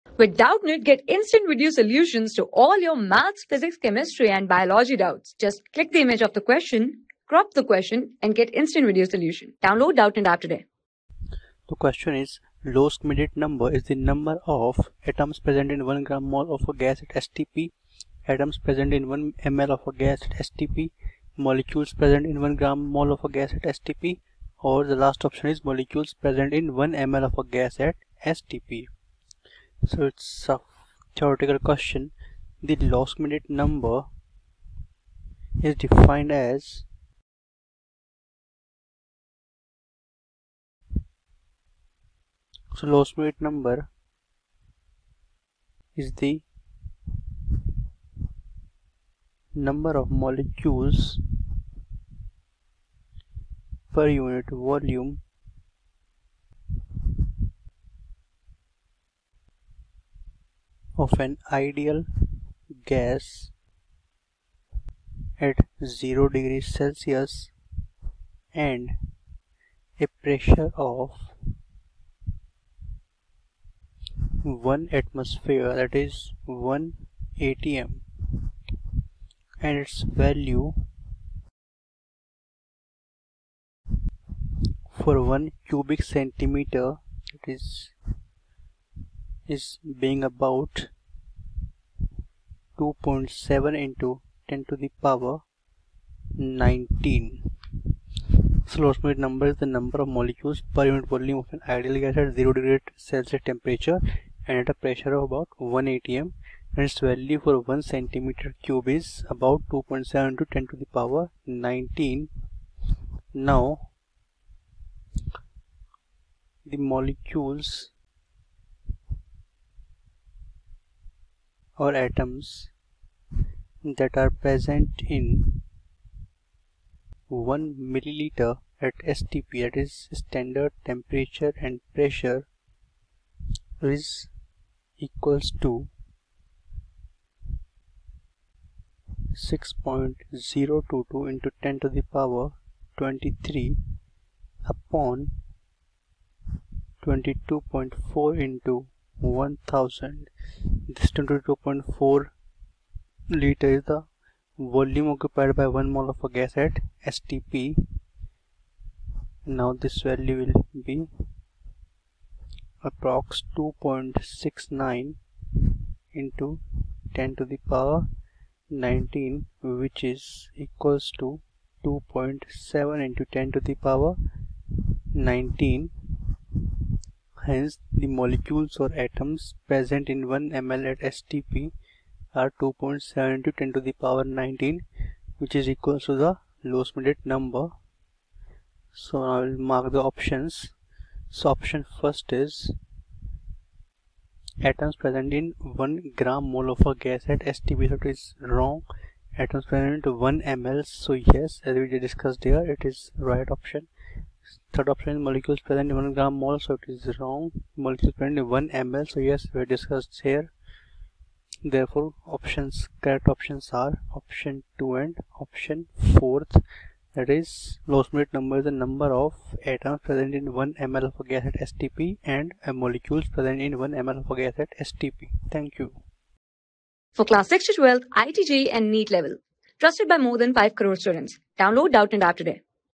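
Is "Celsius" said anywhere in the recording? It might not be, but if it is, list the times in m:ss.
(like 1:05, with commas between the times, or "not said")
1:06, 1:43.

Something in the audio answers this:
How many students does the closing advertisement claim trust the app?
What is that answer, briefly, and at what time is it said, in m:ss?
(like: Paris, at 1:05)
more than 5 crore, at 3:50.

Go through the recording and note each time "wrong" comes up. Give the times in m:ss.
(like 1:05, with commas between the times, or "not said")
3:18, 3:27.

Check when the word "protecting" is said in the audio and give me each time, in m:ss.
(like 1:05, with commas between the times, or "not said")
not said.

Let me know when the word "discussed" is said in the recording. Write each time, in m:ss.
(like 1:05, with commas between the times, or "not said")
3:22, 3:29.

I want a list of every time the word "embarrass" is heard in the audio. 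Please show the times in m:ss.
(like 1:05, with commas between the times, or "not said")
not said.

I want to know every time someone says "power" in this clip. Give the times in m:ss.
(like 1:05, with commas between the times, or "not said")
1:35, 1:50, 2:22, 2:47, 2:53, 3:04.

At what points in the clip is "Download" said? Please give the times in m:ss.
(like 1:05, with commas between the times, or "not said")
0:09, 3:51.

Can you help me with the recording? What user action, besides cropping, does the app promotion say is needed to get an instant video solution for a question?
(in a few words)
click the image.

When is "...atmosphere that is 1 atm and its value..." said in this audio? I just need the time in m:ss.
1:15.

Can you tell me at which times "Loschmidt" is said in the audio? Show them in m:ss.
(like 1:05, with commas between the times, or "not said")
0:12, 0:32, 0:42, 1:38, 3:06, 3:37.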